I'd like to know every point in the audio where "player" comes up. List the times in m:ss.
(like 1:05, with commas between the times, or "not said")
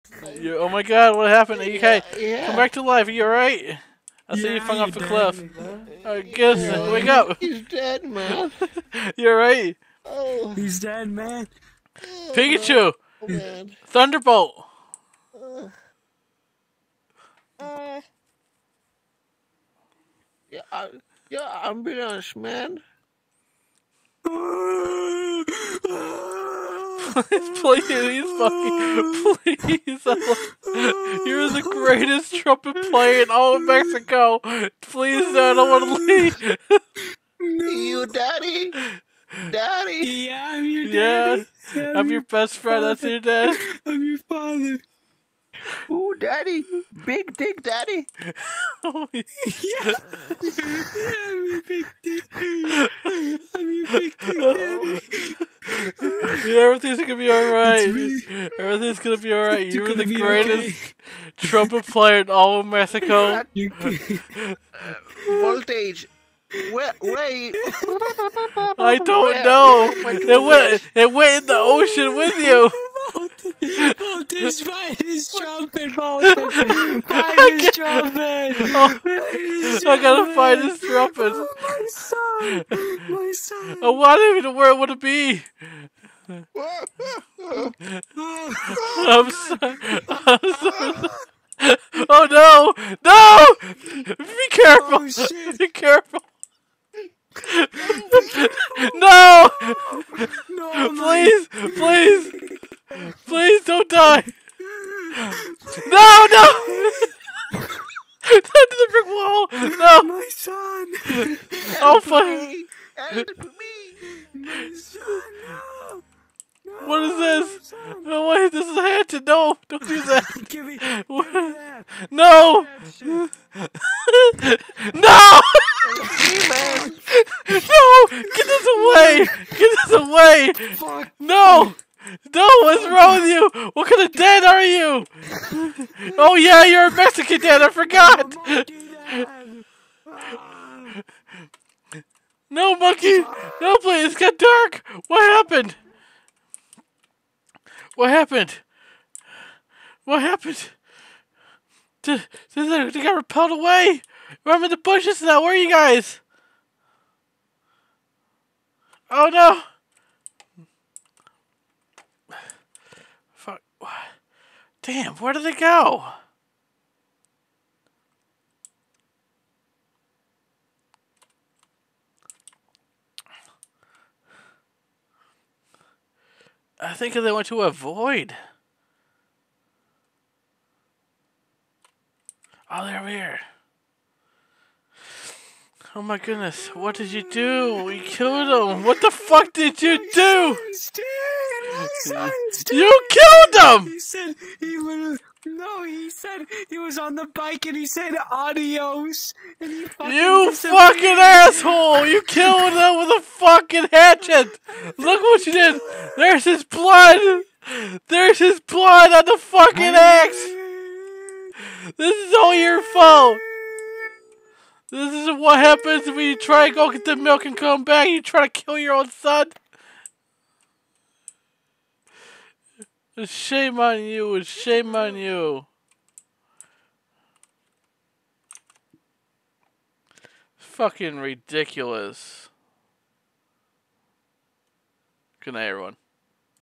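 0:32, 1:01.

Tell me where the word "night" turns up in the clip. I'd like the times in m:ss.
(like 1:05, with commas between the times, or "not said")
3:55.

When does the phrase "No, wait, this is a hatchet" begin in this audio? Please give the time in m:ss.
1:58.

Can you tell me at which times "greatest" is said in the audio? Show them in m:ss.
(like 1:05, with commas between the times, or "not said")
0:31, 1:00.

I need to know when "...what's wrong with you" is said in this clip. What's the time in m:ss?
2:12.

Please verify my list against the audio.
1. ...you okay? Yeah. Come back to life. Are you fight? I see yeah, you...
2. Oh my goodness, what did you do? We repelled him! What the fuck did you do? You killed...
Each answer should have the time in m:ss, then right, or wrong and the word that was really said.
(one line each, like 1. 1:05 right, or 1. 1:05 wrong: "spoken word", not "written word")
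1. 0:01 wrong: "alright", not "fight"
2. 3:05 wrong: "killed", not "repelled".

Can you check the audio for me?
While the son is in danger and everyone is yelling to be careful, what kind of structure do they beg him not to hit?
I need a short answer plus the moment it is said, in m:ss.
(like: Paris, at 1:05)
brick wall, at 1:48.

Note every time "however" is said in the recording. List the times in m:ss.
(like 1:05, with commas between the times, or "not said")
not said.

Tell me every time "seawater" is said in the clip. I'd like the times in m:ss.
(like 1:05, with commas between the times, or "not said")
not said.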